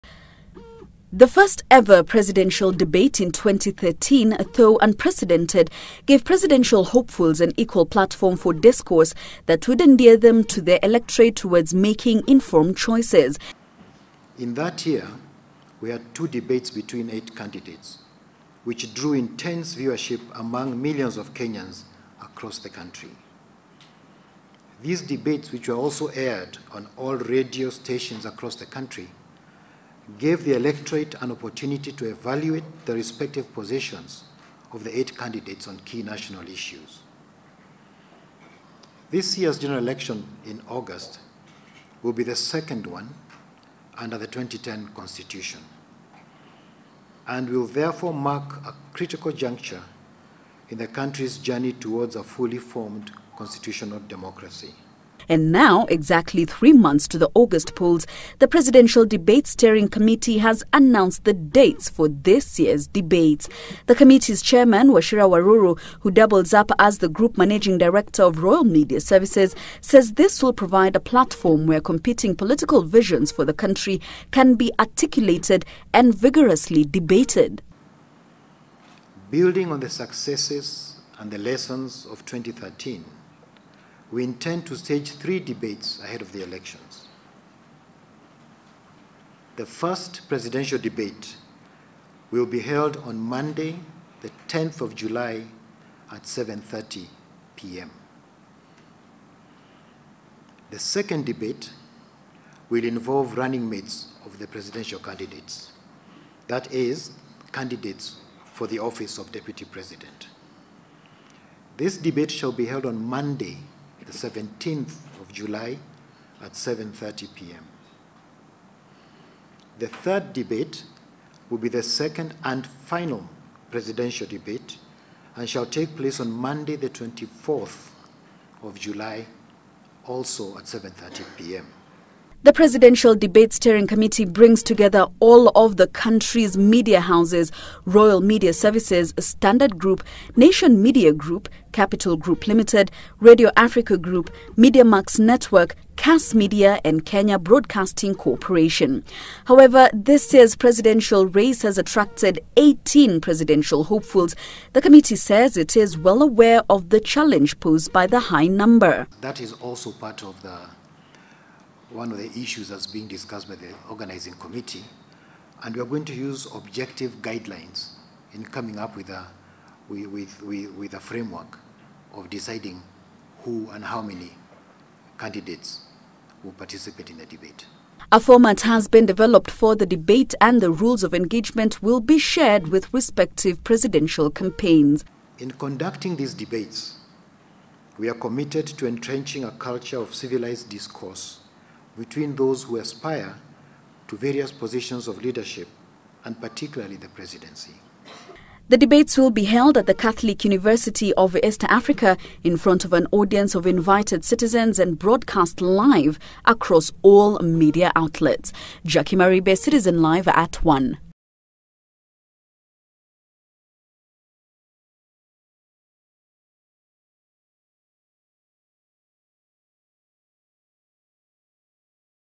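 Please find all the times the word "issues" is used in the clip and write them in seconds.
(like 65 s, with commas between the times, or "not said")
36 s, 162 s.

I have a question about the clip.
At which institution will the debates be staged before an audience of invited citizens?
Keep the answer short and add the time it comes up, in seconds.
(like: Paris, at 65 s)
Catholic University of East Africa, at 199 s.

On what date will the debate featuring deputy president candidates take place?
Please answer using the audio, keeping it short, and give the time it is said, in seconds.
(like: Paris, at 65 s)
17th of July, at 114 s.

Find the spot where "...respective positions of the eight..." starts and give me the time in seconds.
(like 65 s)
32 s.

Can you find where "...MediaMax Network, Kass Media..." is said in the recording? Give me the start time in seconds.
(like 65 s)
144 s.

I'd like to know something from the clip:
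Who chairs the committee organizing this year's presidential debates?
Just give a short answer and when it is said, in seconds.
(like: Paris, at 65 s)
Wachira Waruru, at 64 s.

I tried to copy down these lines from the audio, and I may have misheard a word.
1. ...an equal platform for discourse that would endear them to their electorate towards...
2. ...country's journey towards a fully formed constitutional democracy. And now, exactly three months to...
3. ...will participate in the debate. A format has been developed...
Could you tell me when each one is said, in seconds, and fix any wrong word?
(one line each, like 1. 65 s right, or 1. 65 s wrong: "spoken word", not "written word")
1. 7 s right
2. 50 s right
3. 176 s right.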